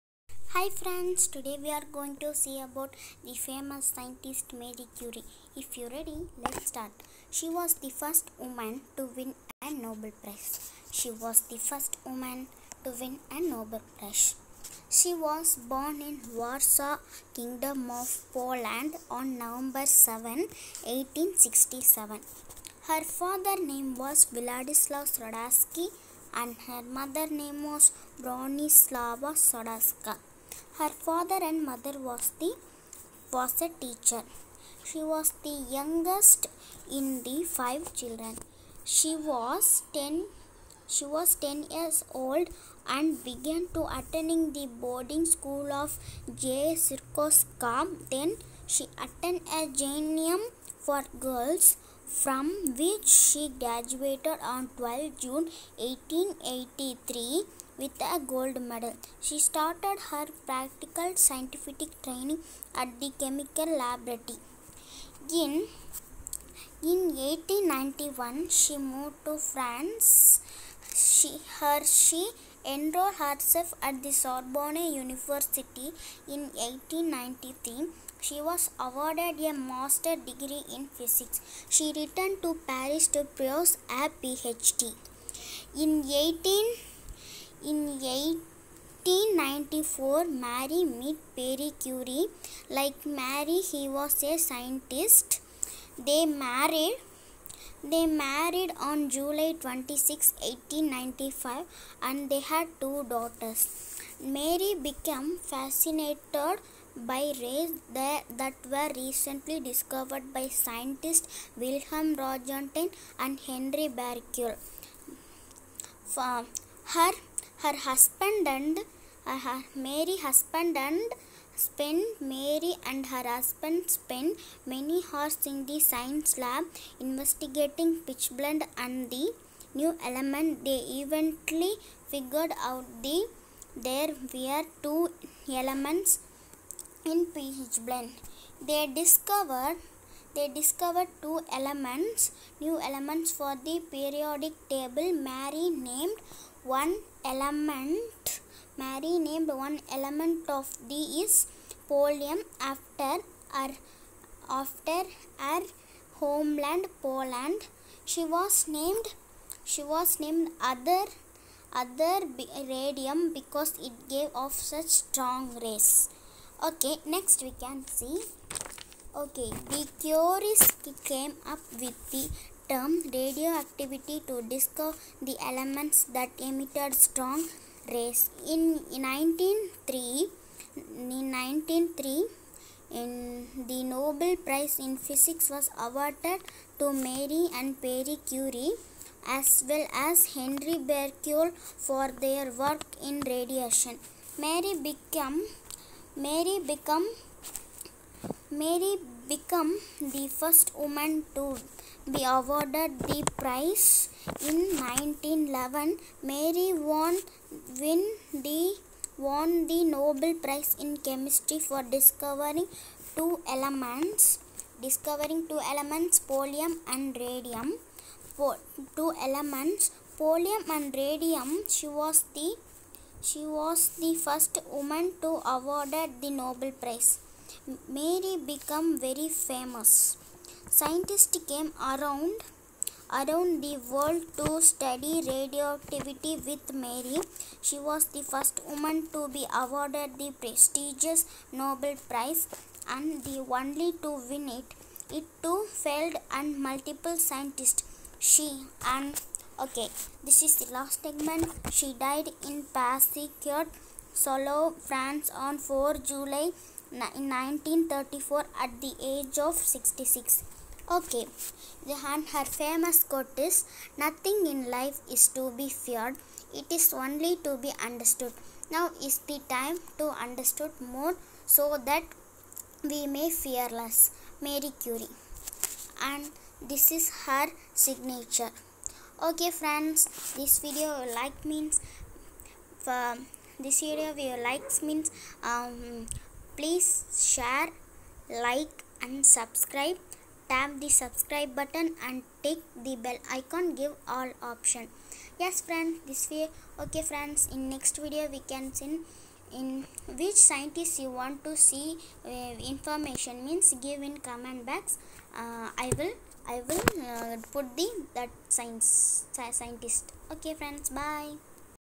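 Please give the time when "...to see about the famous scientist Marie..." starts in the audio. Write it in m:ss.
0:02.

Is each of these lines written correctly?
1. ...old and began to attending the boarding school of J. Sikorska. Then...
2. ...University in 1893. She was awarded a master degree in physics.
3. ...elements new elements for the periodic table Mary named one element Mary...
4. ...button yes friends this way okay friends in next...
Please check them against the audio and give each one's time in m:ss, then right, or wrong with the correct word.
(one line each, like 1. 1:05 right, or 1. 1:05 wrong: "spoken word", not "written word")
1. 0:42 right
2. 1:14 right
3. 2:21 right
4. 4:54 wrong: "option", not "button".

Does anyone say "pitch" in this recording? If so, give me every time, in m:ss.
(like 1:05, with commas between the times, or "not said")
2:08, 2:17.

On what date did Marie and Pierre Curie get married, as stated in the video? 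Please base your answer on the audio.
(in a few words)
July 26, 1895.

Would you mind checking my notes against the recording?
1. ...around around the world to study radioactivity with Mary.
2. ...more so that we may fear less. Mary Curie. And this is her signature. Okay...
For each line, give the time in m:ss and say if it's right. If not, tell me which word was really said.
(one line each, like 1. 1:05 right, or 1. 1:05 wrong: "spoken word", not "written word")
1. 3:51 right
2. 4:30 right.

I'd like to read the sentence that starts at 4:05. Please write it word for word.
It too failed and multiple scientists.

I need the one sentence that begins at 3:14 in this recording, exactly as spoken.
Mary became Mary become Mary become the first woman to be awarded the prize.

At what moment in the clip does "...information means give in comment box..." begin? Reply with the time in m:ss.
5:02.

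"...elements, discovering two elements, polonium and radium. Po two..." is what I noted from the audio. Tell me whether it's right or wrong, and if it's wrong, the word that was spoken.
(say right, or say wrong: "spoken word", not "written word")
right.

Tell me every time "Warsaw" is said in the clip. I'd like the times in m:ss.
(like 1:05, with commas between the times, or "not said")
0:16.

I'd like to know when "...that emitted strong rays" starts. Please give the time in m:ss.
2:56.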